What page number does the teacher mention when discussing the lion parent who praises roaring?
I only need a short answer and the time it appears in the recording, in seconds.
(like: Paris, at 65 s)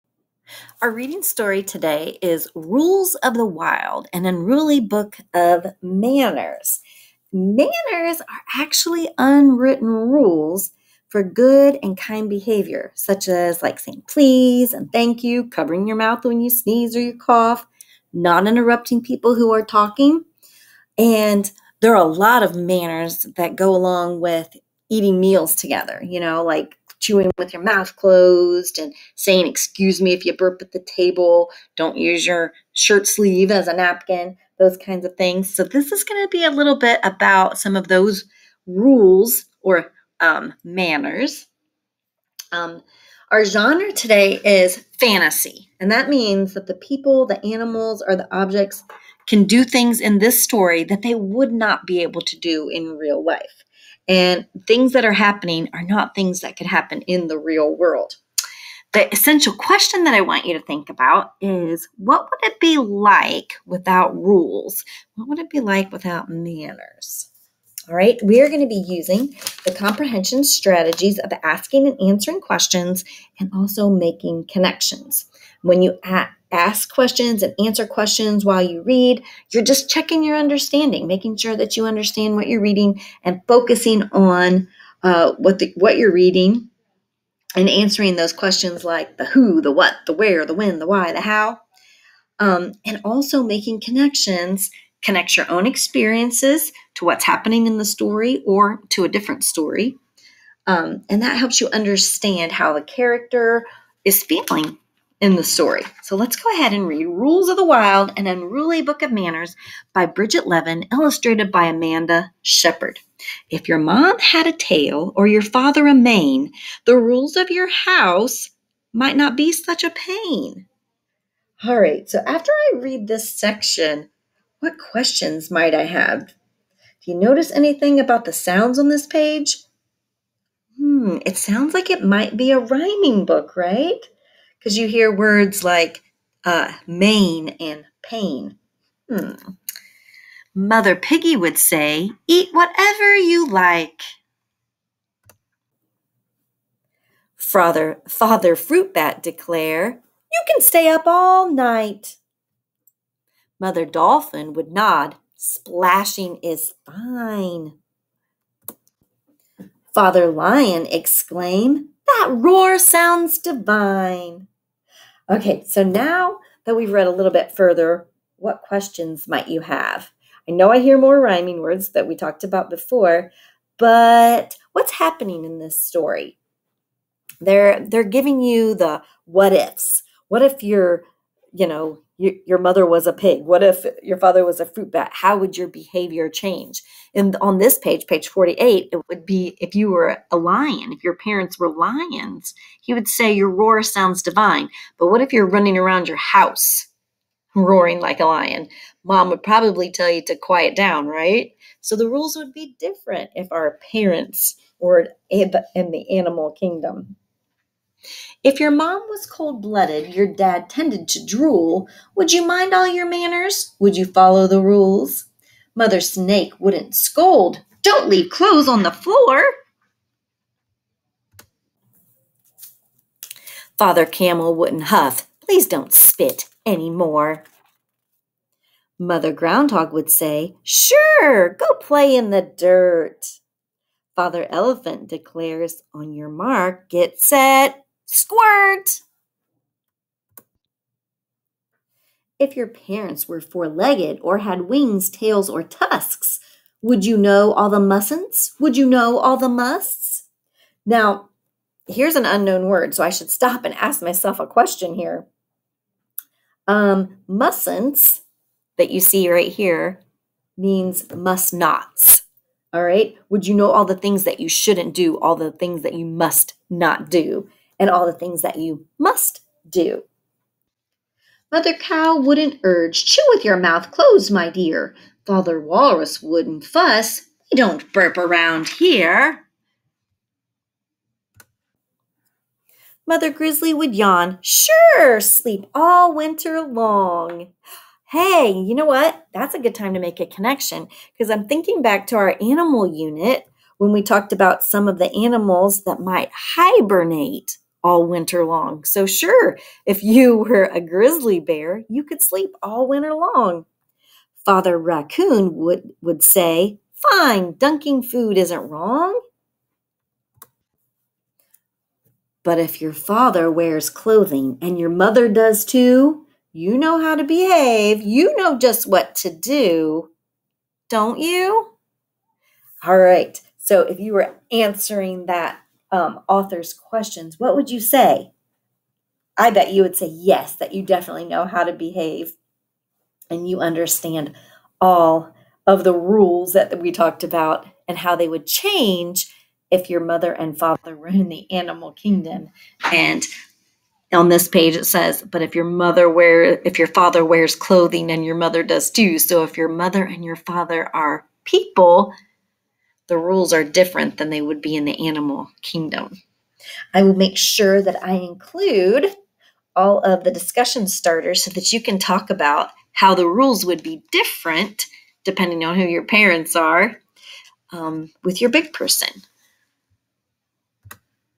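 48, at 188 s.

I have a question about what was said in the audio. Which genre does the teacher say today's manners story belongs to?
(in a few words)
Fantasy.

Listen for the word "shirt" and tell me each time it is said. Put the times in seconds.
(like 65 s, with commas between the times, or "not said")
32 s.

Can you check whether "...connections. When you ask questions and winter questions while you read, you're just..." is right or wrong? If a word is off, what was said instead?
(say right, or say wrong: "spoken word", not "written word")
wrong: "answer", not "winter".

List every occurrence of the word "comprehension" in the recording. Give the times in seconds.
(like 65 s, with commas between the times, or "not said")
69 s.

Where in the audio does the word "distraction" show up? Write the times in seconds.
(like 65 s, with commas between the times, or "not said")
not said.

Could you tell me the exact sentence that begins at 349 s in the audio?
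So if your mother and your father are people, the rules are different than they would be in the animal kingdom.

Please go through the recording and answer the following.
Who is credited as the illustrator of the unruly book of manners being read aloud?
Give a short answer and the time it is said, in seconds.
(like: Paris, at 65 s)
Amanda Shepherd, at 111 s.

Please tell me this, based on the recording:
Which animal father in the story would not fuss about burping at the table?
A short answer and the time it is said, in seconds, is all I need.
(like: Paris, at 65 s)
Walrus, at 275 s.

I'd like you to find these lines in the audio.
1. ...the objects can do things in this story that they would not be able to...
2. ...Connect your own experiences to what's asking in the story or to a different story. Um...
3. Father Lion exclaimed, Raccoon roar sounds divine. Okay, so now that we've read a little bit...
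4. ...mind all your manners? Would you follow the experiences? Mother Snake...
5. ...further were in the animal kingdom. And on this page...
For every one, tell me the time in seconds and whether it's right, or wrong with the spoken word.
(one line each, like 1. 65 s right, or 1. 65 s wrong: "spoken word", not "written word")
1. 48 s right
2. 95 s wrong: "happening", not "asking"
3. 159 s wrong: "That", not "Raccoon"
4. 212 s wrong: "rules", not "experiences"
5. 340 s wrong: "father", not "further".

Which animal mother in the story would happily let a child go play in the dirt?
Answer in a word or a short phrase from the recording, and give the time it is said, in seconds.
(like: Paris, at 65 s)
Groundhog, at 228 s.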